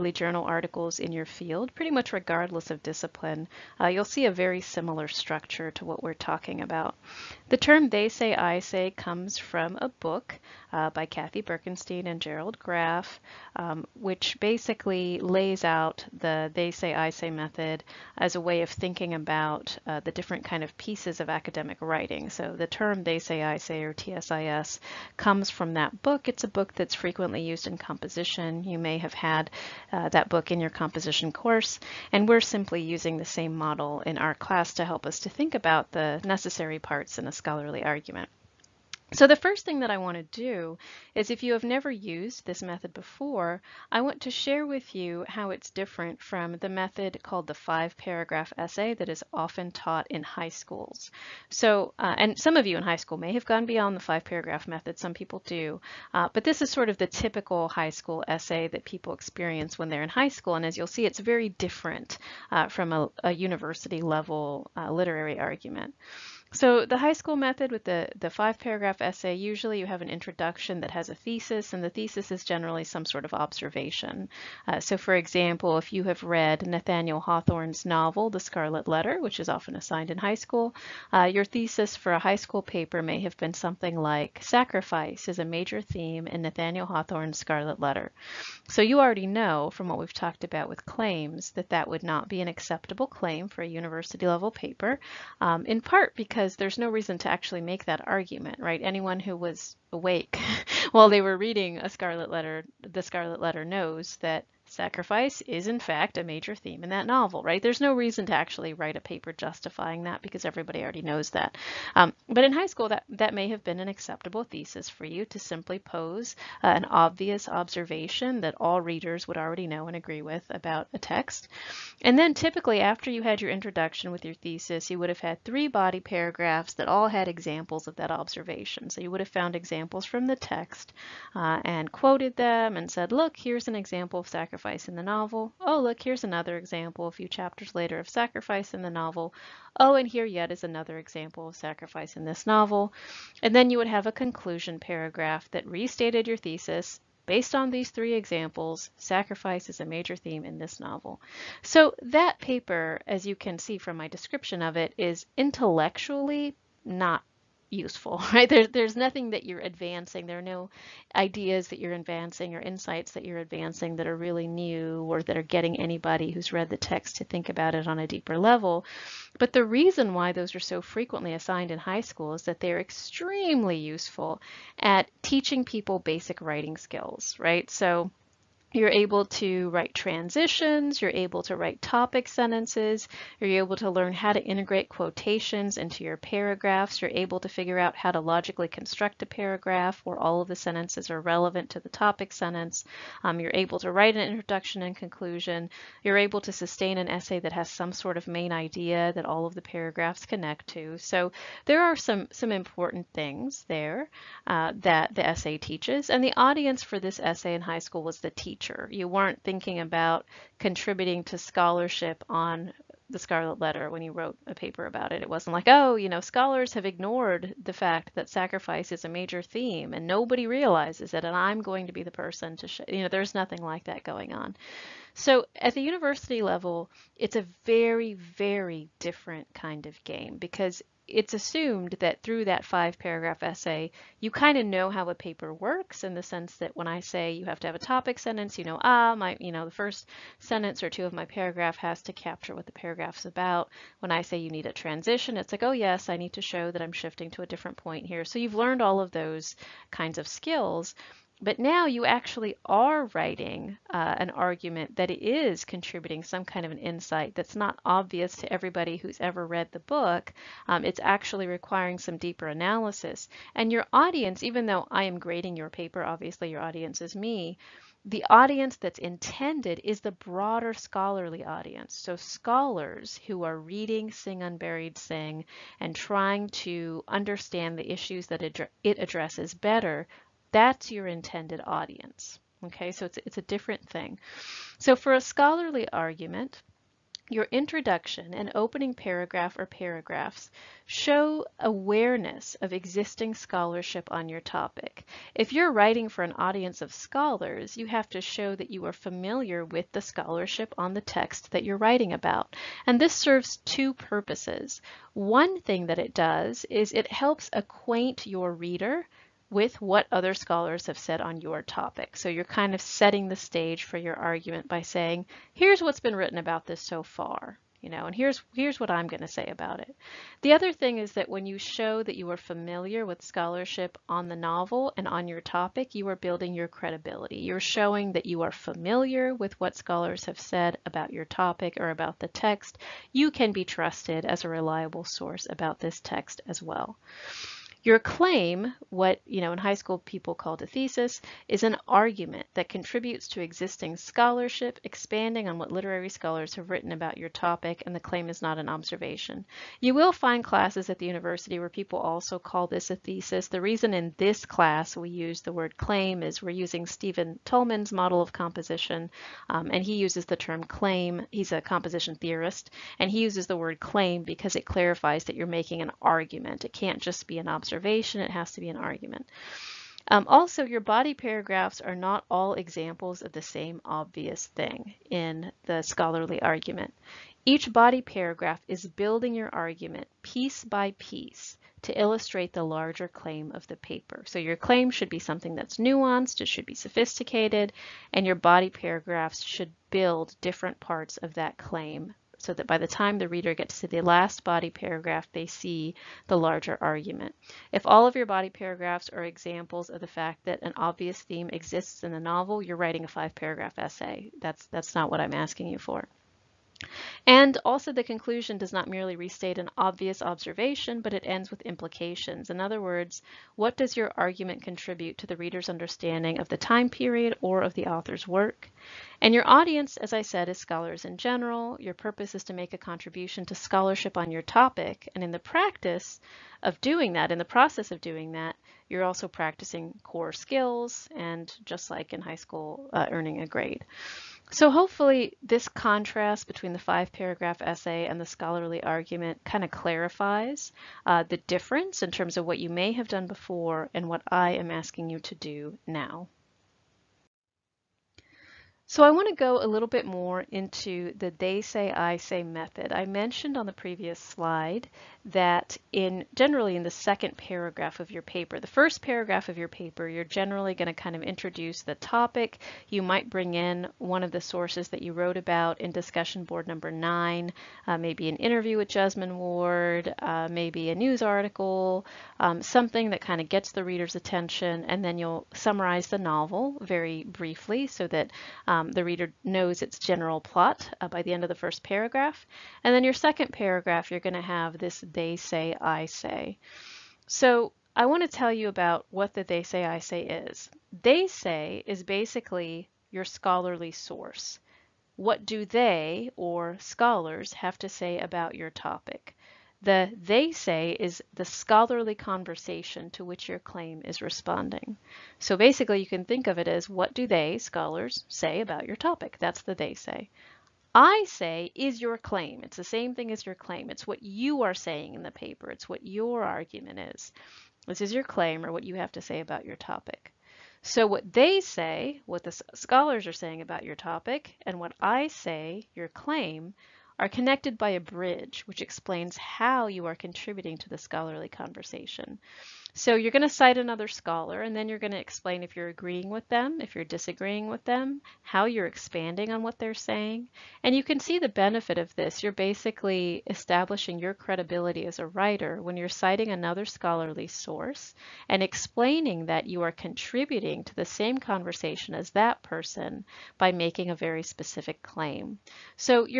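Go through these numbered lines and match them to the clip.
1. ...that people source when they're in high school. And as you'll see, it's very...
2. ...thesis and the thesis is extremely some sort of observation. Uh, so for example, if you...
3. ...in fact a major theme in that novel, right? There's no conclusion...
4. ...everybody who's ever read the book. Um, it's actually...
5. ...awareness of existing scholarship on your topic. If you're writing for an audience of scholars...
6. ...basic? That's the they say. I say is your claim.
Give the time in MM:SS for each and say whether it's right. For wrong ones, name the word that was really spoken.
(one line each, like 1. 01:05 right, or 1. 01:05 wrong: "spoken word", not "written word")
1. 00:58 wrong: "experience", not "source"
2. 01:11 wrong: "generally", not "extremely"
3. 01:45 wrong: "reason", not "conclusion"
4. 04:18 right
5. 04:51 right
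6. 08:28 wrong: "topic", not "basic".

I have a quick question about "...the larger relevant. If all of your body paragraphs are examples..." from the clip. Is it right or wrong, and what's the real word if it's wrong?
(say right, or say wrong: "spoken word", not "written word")
wrong: "argument", not "relevant".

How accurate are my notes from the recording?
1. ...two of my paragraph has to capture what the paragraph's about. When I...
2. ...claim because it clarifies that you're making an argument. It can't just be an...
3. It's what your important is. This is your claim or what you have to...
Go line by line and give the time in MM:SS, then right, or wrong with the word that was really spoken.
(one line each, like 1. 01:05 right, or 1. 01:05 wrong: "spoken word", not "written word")
1. 04:00 right
2. 06:03 right
3. 08:35 wrong: "argument", not "important".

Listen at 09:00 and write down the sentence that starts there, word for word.
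And you can see the benefit of this.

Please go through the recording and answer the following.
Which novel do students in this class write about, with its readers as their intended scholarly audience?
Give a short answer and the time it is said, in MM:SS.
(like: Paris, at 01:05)
Sing Unburied Sing, at 04:34.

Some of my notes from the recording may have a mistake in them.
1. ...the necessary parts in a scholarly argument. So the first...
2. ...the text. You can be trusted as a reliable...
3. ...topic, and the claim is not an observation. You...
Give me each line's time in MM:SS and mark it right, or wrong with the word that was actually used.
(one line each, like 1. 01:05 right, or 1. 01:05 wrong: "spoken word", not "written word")
1. 00:35 right
2. 05:32 right
3. 05:47 right.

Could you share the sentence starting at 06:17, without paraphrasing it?
Each body paragraph is building your argument piece by piece to illustrate the larger claim of the paper.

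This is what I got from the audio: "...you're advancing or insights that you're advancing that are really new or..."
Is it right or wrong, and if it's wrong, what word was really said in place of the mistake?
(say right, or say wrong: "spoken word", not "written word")
right.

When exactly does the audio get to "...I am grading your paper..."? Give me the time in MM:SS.
04:24.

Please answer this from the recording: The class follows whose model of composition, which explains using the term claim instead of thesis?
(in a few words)
Stephen Toulmin.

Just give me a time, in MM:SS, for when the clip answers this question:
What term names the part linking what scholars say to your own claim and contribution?
08:48.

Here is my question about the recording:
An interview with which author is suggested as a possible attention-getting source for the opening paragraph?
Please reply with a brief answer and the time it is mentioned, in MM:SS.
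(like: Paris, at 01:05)
Jesmyn Ward, at 07:48.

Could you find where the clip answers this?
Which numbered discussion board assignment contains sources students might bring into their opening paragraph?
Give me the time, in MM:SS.
07:46.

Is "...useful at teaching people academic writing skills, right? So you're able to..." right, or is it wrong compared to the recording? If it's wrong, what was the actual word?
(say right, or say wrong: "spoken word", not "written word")
wrong: "basic", not "academic".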